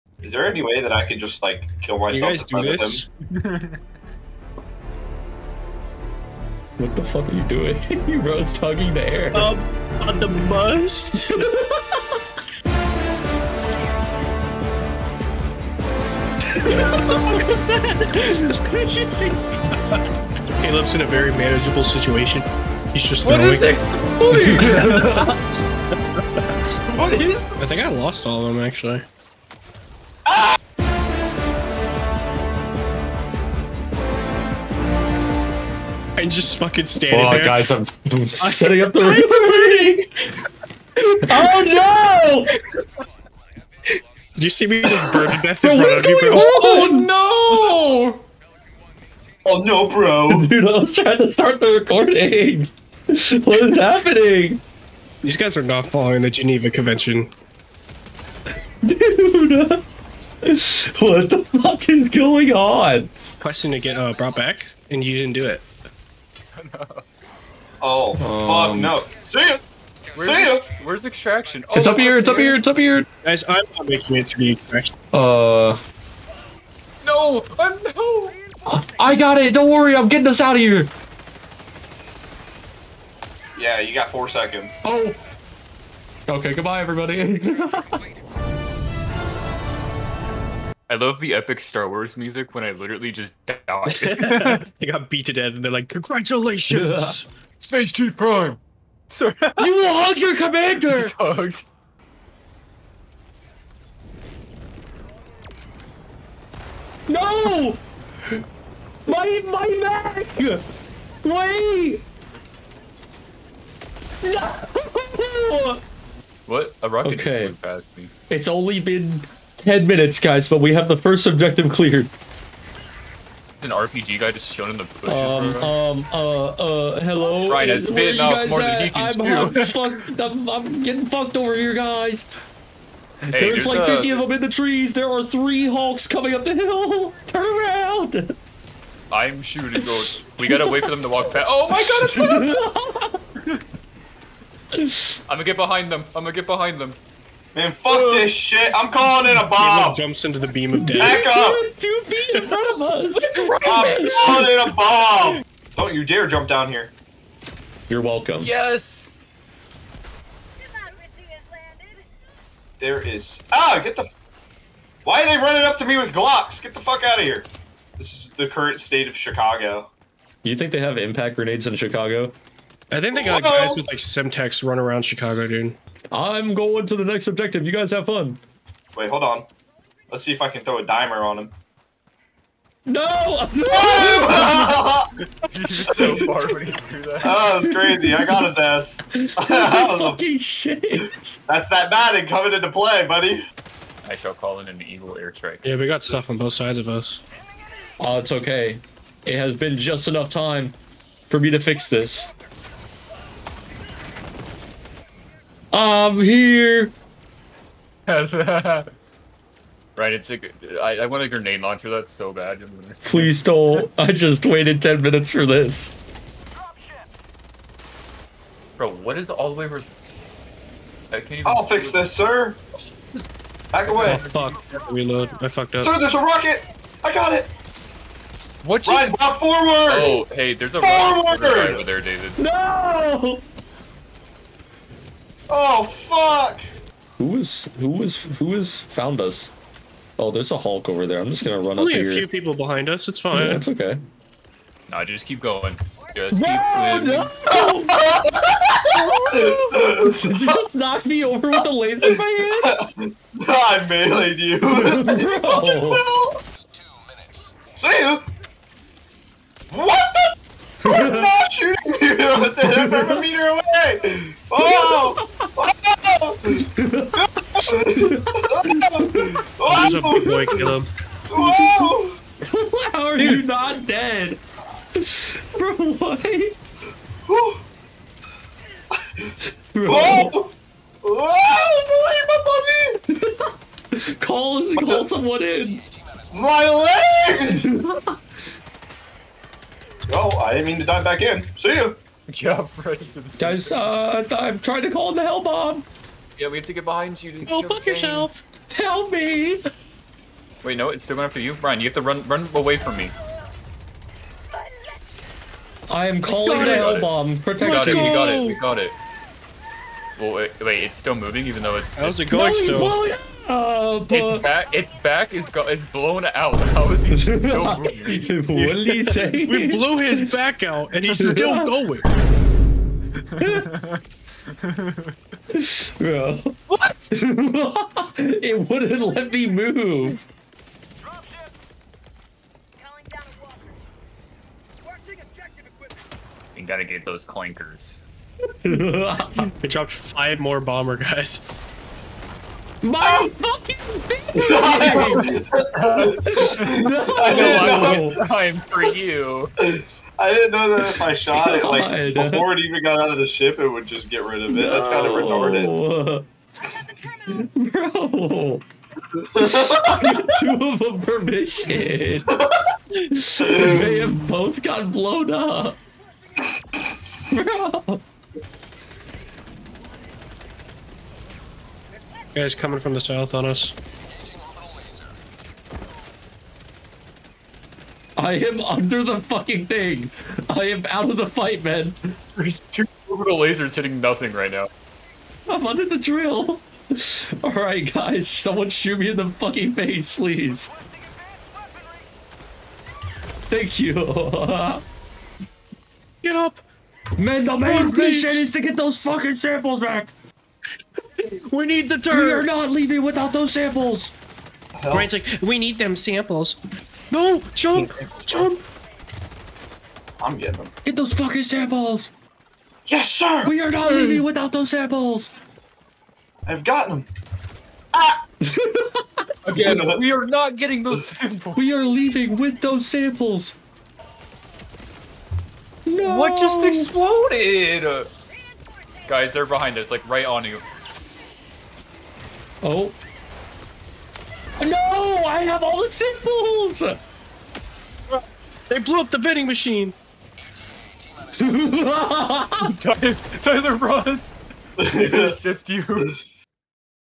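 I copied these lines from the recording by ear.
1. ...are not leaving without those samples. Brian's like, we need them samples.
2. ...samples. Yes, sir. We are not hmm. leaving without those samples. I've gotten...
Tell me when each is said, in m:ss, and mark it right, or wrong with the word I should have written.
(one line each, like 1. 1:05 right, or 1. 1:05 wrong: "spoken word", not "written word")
1. 6:42 right
2. 6:51 right.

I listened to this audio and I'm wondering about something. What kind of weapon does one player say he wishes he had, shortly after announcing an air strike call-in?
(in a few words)
Grenade launcher.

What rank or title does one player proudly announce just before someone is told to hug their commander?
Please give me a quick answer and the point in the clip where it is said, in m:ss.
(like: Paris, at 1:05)
Space Chief Prime, at 1:37.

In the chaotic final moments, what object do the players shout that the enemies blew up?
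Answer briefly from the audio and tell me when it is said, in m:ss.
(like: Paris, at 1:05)
Vending machine, at 7:19.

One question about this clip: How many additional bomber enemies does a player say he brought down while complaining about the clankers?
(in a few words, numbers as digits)
5.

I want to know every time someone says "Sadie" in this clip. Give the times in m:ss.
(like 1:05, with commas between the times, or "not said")
not said.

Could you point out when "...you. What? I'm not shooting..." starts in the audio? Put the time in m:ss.
4:18.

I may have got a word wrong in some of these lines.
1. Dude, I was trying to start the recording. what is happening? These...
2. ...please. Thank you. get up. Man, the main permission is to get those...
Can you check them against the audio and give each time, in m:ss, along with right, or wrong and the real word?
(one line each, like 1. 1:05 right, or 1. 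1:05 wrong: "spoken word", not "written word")
1. 0:50 right
2. 6:30 wrong: "mission", not "permission".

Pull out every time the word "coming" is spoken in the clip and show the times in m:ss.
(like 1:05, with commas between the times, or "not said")
2:16, 3:12, 6:12.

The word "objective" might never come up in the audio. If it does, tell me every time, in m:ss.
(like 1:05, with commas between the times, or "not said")
2:01, 2:57.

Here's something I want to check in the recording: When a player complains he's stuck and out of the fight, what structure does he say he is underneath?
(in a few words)
The drill.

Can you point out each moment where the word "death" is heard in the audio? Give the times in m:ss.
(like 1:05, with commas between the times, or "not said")
0:45, 1:35, 2:30.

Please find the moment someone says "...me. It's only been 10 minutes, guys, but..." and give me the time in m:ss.
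1:57.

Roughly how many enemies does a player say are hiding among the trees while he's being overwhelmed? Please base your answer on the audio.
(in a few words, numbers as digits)
50.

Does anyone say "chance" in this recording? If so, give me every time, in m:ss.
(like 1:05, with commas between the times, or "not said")
not said.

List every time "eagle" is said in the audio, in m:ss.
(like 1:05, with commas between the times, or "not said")
3:14.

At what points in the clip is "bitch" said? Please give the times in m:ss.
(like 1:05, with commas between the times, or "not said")
5:44.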